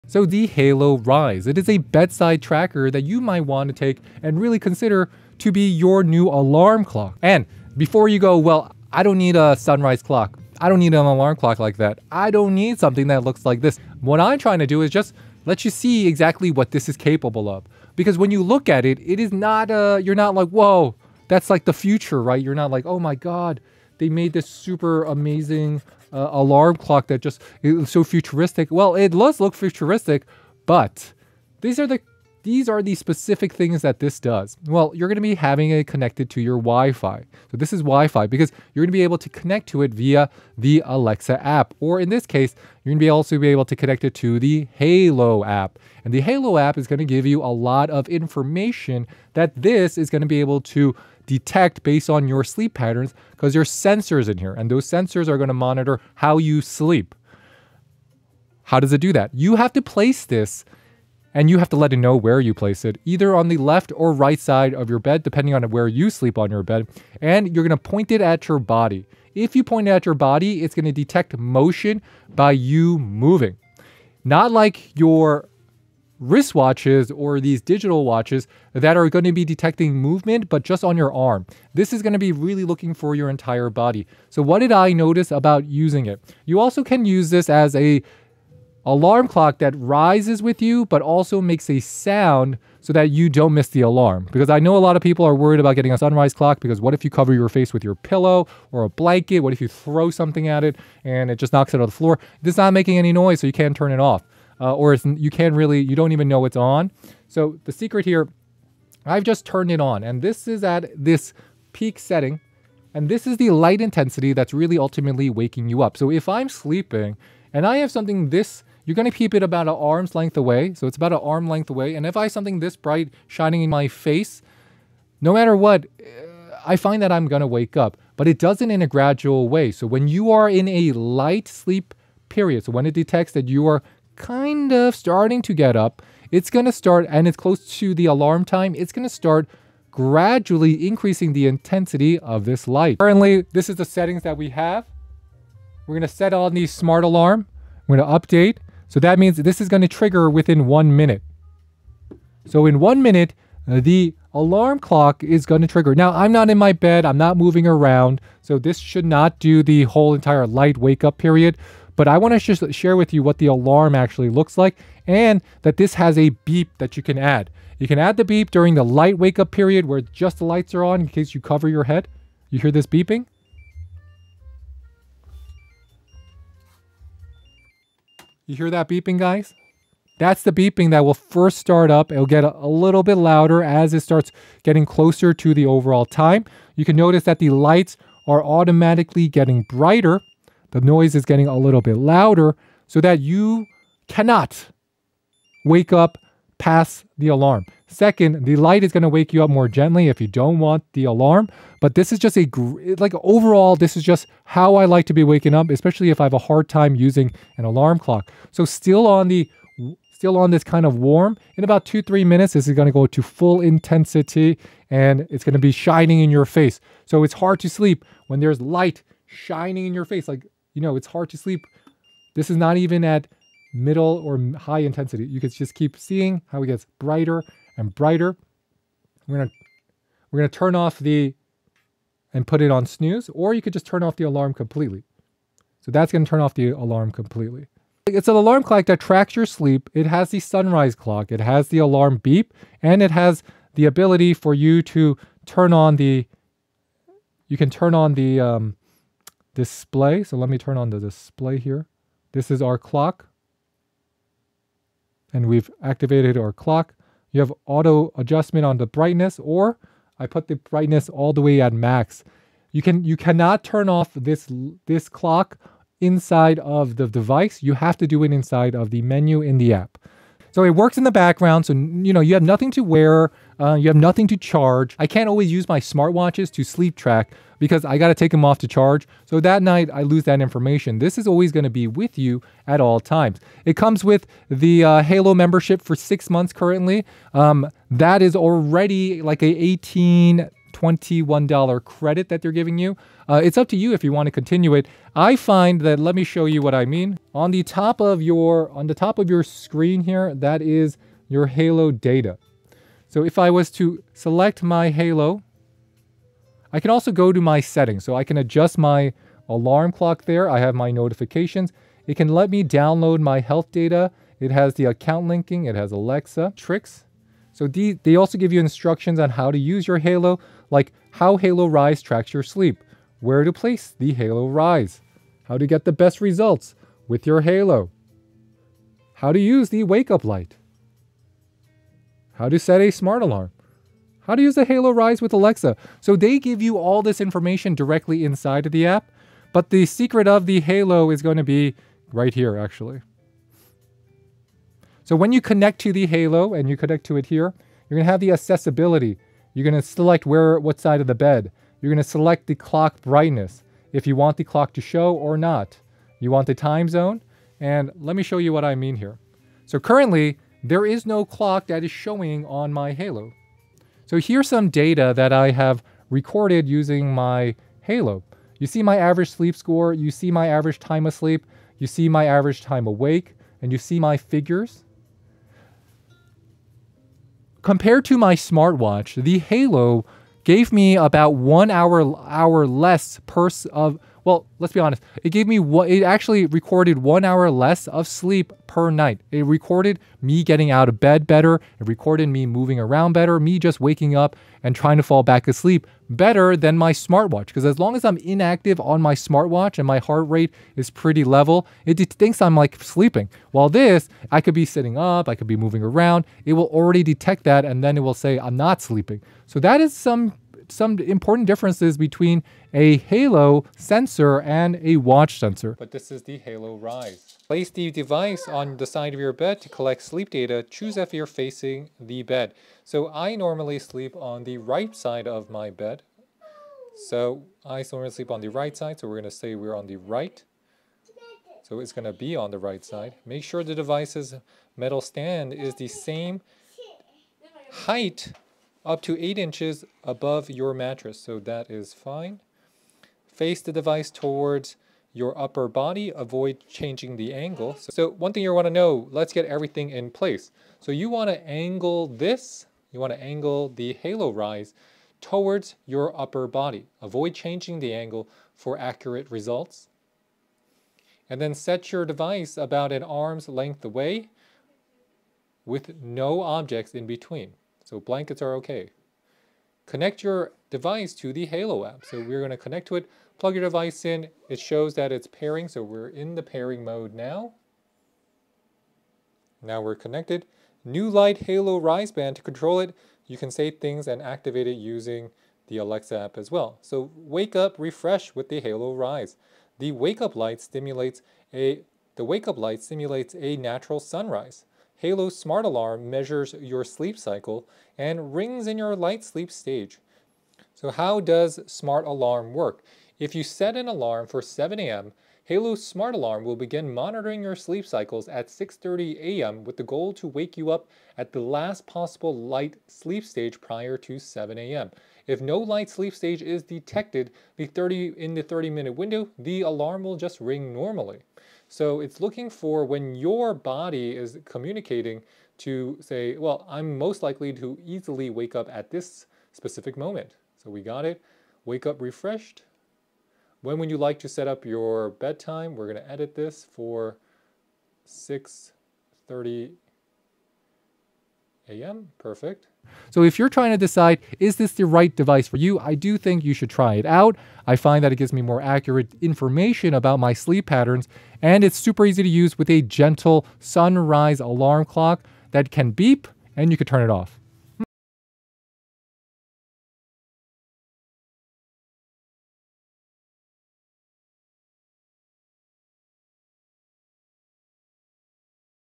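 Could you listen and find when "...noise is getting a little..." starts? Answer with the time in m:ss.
3:10.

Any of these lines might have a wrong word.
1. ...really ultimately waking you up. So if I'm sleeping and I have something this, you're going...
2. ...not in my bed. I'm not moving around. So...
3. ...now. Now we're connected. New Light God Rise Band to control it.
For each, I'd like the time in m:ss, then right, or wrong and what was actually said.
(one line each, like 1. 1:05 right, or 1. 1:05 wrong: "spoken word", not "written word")
1. 1:54 right
2. 2:36 right
3. 7:57 wrong: "Halo", not "God".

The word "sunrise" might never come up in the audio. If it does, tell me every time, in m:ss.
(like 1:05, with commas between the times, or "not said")
0:09, 1:35, 4:00, 8:13, 9:13.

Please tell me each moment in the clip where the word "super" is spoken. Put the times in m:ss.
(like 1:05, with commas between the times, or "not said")
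0:24, 9:11.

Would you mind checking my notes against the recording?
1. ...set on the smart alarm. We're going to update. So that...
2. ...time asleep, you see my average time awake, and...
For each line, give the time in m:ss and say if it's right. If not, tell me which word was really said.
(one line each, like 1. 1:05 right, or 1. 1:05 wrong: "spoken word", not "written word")
1. 2:26 right
2. 6:10 right.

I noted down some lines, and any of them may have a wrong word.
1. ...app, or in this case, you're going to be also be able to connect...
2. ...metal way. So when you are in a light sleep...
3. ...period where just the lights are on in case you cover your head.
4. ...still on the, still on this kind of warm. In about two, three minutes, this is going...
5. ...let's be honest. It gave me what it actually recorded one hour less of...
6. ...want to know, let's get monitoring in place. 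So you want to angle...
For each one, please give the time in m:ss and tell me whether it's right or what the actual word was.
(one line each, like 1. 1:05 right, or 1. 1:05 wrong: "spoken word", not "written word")
1. 0:41 right
2. 2:08 wrong: "gradual", not "metal"
3. 2:49 right
4. 3:28 right
5. 6:24 right
6. 7:28 wrong: "everything", not "monitoring".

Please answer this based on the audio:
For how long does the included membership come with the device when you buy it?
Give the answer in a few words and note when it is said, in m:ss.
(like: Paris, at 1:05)
6 months, at 4:45.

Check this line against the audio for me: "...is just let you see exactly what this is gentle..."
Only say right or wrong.
wrong.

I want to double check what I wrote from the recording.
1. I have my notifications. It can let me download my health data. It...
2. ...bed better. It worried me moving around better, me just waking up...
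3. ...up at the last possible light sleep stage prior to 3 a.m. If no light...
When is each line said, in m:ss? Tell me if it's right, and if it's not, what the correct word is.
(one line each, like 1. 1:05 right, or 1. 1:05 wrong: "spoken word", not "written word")
1. 5:10 right
2. 6:30 wrong: "recorded", not "worried"
3. 8:30 wrong: "7", not "3".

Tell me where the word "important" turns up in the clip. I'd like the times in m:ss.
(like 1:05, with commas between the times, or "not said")
6:50.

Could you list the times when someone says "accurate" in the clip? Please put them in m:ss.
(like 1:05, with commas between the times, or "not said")
7:38, 9:08.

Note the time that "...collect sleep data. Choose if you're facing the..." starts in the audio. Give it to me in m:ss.
6:59.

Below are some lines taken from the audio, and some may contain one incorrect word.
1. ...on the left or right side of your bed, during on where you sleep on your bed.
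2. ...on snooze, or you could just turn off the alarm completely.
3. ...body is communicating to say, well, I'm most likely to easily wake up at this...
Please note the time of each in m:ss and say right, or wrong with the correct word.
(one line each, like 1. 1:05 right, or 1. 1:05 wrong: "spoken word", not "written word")
1. 1:03 wrong: "depending", not "during"
2. 3:52 right
3. 8:43 right.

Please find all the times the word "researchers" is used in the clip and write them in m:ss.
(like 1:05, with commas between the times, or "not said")
not said.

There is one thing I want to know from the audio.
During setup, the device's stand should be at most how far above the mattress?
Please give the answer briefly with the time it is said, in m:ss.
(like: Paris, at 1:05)
8 inches, at 7:19.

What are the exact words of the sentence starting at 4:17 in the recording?
You have auto adjustment on the brightness or I put the brightness all the way at max.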